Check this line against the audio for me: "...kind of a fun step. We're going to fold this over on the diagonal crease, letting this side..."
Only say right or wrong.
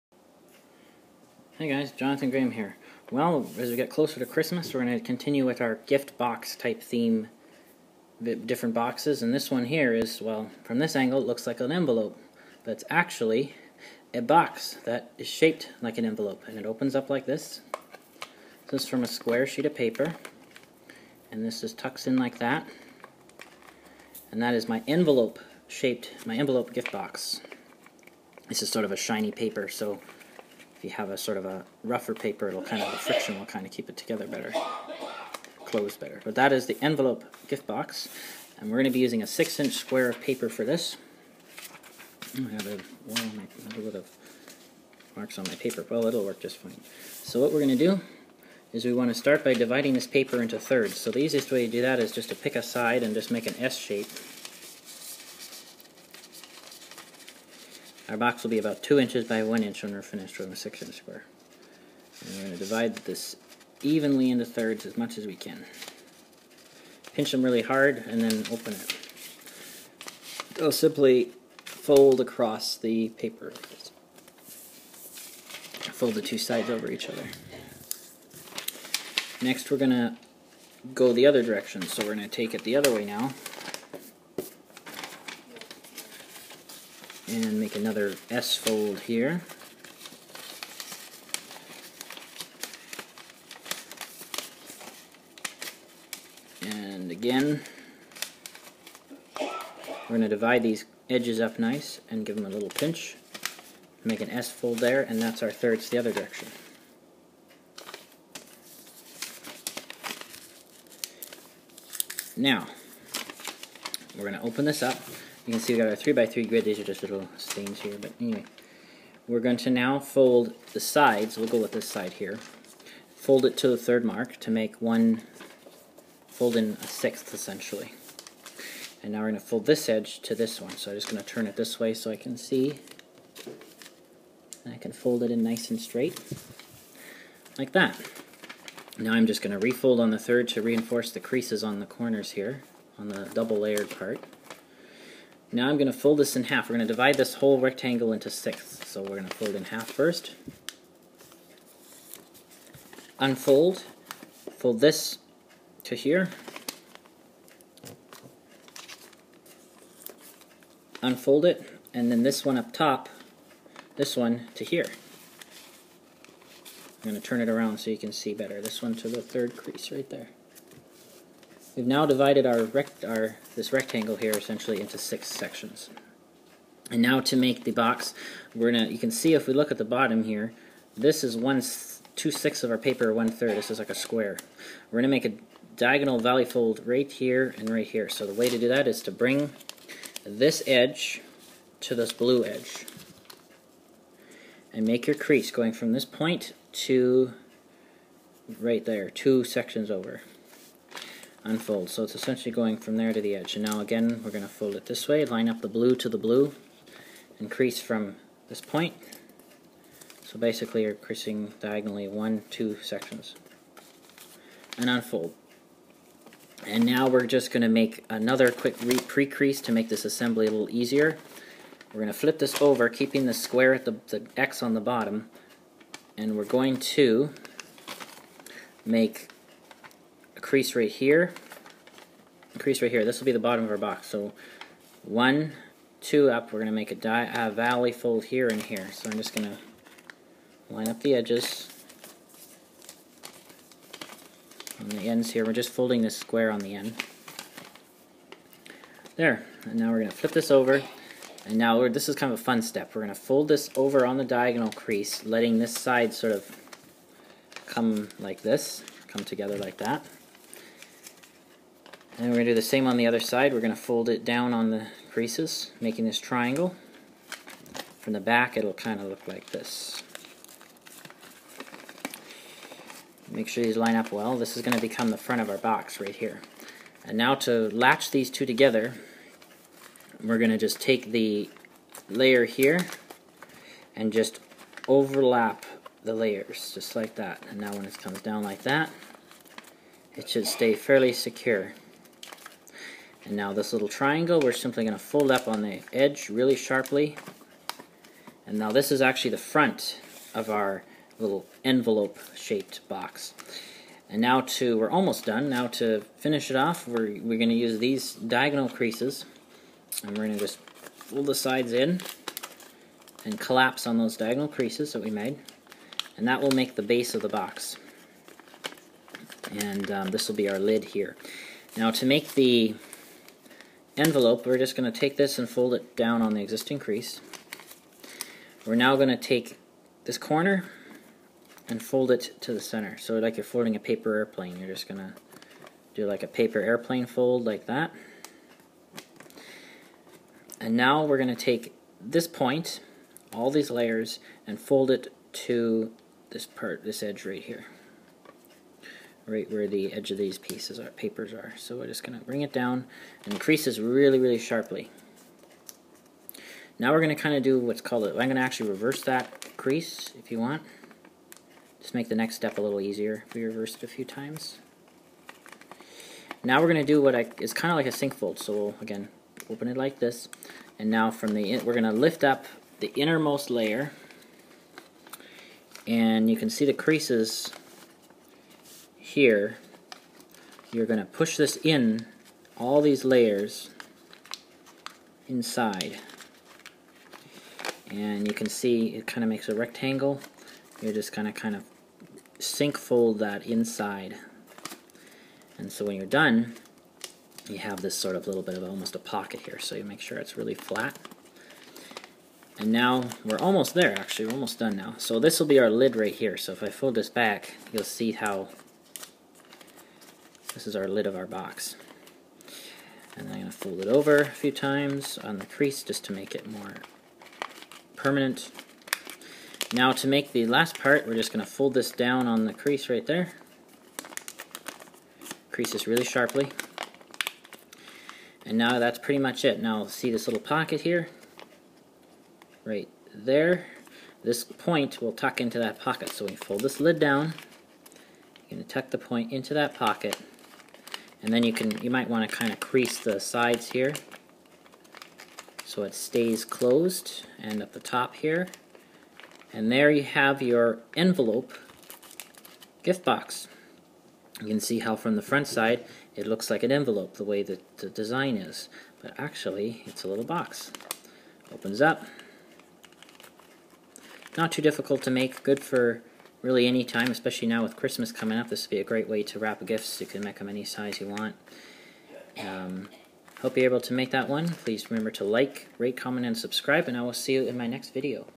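right.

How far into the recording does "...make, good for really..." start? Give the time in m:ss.
7:45.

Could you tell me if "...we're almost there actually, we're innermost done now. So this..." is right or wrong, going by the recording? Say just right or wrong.
wrong.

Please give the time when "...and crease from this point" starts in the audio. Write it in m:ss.
3:27.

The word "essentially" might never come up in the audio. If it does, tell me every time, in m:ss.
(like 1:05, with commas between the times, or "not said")
2:07, 2:54, 3:22.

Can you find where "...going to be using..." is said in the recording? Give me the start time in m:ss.
0:38.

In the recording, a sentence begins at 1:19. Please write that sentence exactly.
Next we're going to go the other direction, so we're going to take it the other way now.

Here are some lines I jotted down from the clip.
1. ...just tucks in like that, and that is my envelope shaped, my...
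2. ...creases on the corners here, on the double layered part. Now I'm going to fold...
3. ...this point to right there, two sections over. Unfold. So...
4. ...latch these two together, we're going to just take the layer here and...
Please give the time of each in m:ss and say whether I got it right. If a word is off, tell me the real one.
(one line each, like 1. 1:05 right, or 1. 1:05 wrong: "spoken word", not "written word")
1. 0:21 right
2. 2:21 right
3. 3:15 right
4. 4:37 right.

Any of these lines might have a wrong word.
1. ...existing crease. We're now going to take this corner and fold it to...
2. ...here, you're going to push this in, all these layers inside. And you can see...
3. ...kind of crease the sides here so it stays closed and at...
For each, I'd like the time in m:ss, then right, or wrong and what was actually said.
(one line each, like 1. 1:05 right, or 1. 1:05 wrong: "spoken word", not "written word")
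1. 5:26 right
2. 6:19 right
3. 7:22 right.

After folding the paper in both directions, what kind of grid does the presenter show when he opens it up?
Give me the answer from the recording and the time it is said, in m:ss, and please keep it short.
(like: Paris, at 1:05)
3x3 grid, at 1:55.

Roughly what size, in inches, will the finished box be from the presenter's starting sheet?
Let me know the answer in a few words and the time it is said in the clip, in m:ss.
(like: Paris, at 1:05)
2 inches by 1 inch, at 0:58.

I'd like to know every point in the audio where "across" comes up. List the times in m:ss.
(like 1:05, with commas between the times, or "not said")
1:12.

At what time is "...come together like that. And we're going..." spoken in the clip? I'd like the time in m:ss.
4:19.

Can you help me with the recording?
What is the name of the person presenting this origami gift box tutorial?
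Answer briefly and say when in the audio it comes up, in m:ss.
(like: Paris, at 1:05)
Jonathan Graham, at 0:01.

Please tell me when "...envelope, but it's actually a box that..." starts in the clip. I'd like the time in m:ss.
0:11.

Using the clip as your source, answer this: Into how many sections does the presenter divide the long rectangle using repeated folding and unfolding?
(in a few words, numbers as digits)
6.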